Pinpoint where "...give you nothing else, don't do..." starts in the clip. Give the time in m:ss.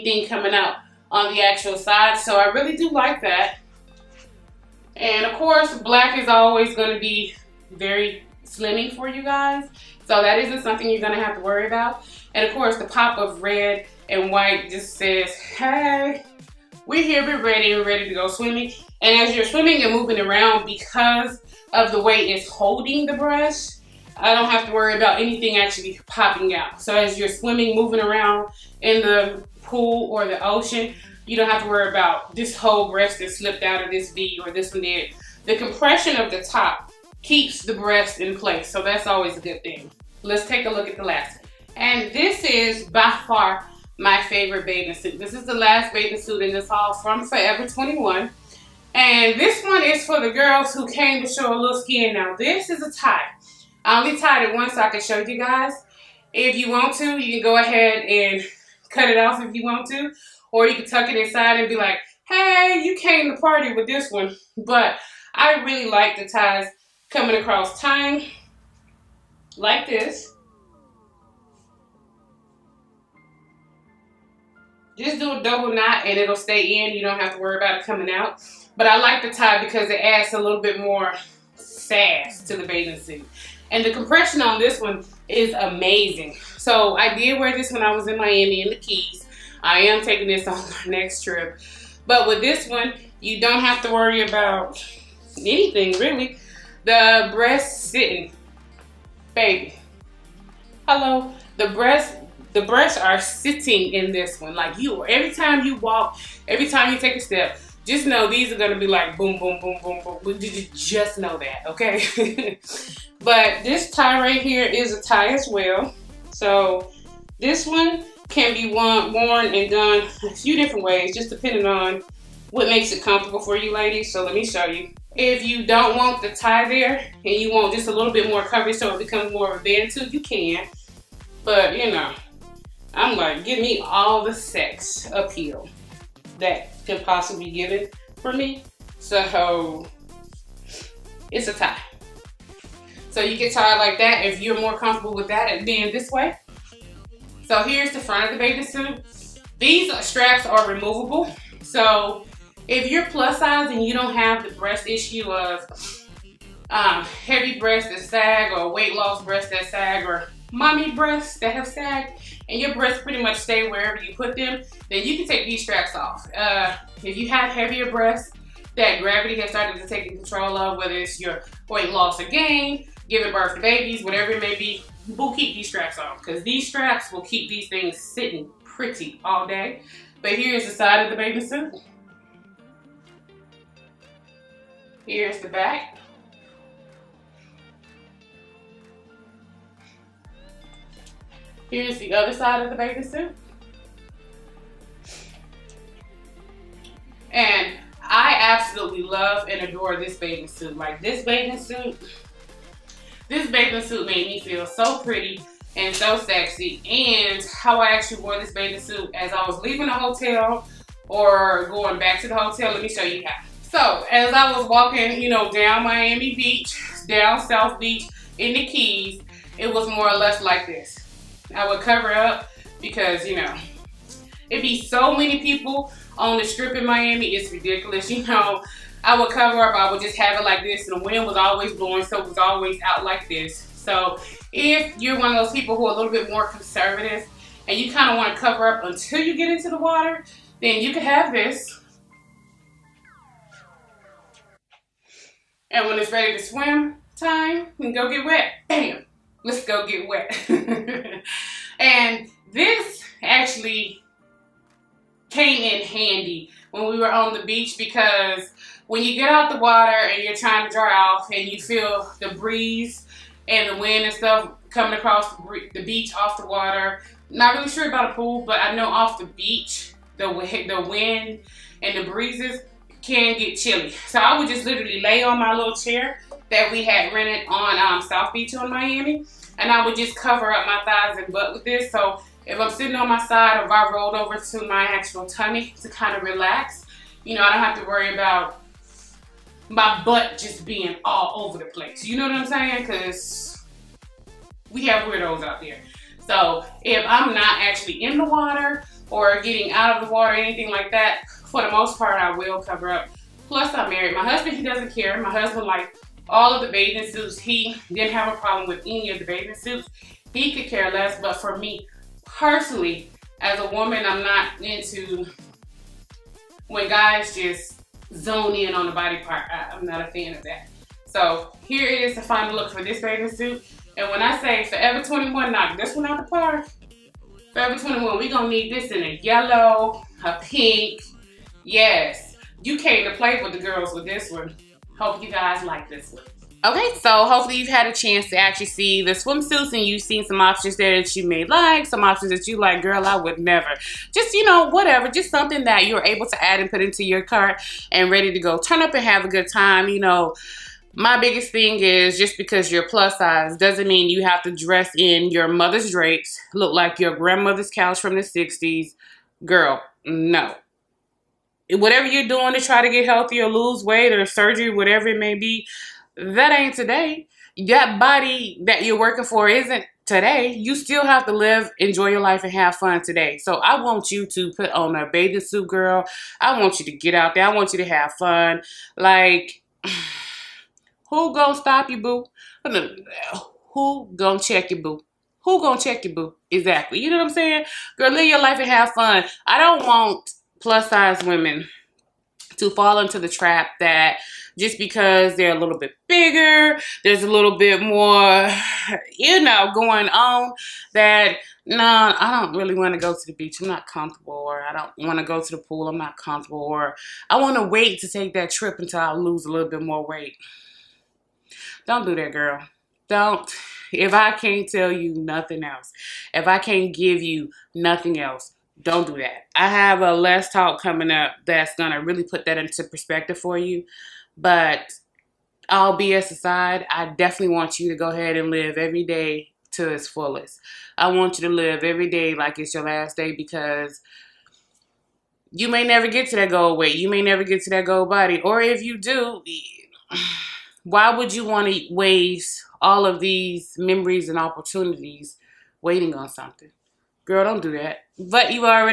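6:56.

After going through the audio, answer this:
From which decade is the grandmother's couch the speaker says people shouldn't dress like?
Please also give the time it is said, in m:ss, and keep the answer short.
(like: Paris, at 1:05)
the 60s, at 5:58.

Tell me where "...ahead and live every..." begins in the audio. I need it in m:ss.
7:08.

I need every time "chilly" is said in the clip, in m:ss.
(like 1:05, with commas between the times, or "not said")
4:33.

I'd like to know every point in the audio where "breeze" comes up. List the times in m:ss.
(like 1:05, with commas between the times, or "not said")
4:22, 4:32.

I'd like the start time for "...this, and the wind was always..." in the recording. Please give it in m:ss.
3:50.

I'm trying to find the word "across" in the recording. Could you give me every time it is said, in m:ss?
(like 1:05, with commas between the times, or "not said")
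1:07, 4:24.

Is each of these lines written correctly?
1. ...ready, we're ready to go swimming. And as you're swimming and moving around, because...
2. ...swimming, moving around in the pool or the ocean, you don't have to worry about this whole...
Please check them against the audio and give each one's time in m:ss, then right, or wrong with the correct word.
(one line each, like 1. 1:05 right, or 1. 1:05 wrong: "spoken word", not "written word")
1. 0:17 right
2. 0:27 right.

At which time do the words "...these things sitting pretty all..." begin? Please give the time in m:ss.
2:57.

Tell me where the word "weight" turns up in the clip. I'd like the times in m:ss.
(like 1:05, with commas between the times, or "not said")
2:38, 2:51, 6:03, 6:50, 7:16.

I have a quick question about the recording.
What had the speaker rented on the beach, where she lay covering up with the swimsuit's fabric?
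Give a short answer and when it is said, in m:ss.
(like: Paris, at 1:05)
chair, at 4:35.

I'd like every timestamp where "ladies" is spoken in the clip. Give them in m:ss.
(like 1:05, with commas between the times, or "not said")
2:03.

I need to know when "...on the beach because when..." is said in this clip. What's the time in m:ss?
4:17.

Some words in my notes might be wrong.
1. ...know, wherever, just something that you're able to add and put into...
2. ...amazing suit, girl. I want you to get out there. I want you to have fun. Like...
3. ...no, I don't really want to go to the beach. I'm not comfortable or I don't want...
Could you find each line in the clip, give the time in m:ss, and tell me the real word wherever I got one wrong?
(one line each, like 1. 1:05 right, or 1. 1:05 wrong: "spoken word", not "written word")
1. 5:44 wrong: "whatever", not "wherever"
2. 6:15 wrong: "bathing", not "amazing"
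3. 6:41 right.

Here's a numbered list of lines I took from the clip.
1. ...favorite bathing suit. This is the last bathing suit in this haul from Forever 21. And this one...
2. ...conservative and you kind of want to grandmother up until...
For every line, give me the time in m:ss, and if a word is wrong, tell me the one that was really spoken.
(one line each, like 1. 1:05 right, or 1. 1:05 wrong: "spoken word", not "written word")
1. 0:44 right
2. 3:56 wrong: "cover", not "grandmother".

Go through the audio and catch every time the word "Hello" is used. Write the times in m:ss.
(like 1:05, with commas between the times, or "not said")
1:40.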